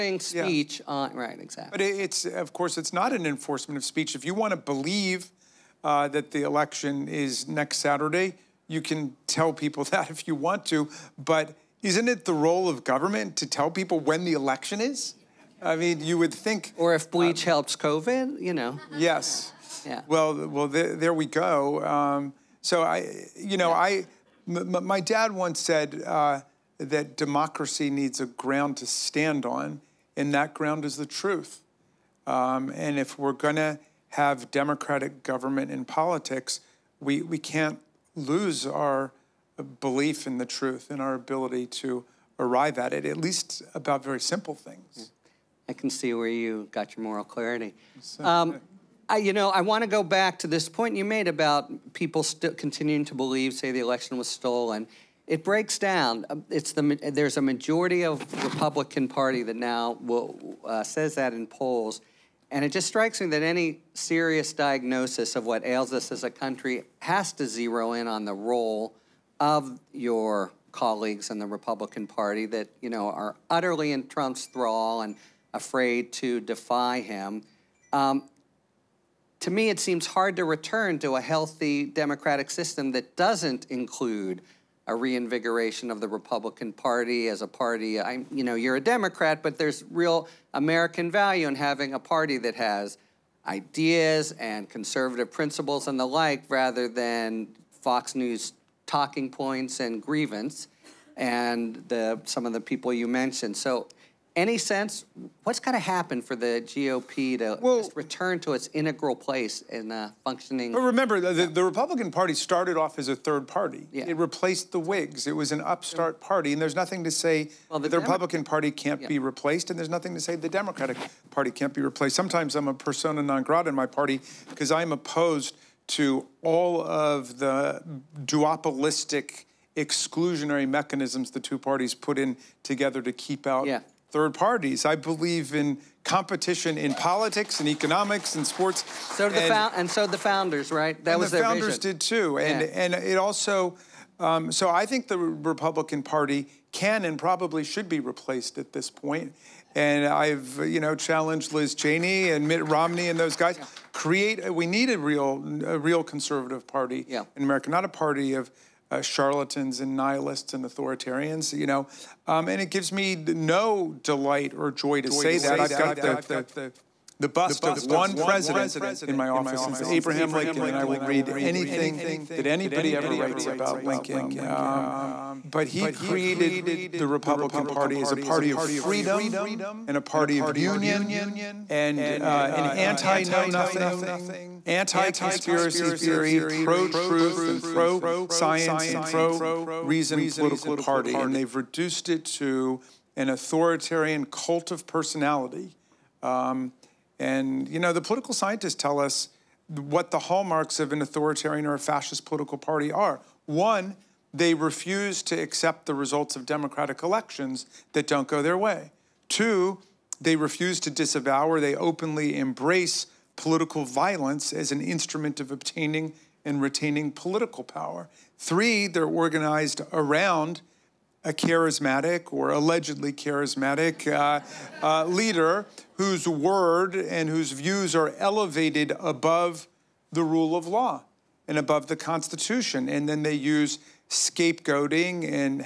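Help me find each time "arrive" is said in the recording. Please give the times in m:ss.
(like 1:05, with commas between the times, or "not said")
0:42.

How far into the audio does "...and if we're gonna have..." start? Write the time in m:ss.
0:32.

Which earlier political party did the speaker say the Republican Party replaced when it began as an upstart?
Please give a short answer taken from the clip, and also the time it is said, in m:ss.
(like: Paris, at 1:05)
the Whigs, at 1:54.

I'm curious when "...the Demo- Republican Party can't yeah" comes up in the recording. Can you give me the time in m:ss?
1:57.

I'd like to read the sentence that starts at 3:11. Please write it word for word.
And they've reduced it to an authoritarian cult of personality.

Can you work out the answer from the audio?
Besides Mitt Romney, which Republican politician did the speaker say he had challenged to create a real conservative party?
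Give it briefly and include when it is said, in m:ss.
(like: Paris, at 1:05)
Liz Cheney, at 2:31.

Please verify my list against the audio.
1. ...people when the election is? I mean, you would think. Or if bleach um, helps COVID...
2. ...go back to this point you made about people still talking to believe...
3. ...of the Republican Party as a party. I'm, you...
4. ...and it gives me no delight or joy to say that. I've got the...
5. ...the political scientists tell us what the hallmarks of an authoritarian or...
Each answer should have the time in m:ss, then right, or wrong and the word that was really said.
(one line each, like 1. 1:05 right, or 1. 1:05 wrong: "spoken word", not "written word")
1. 0:13 right
2. 0:49 wrong: "continuing", not "talking"
3. 1:25 right
4. 2:42 right
5. 3:17 right.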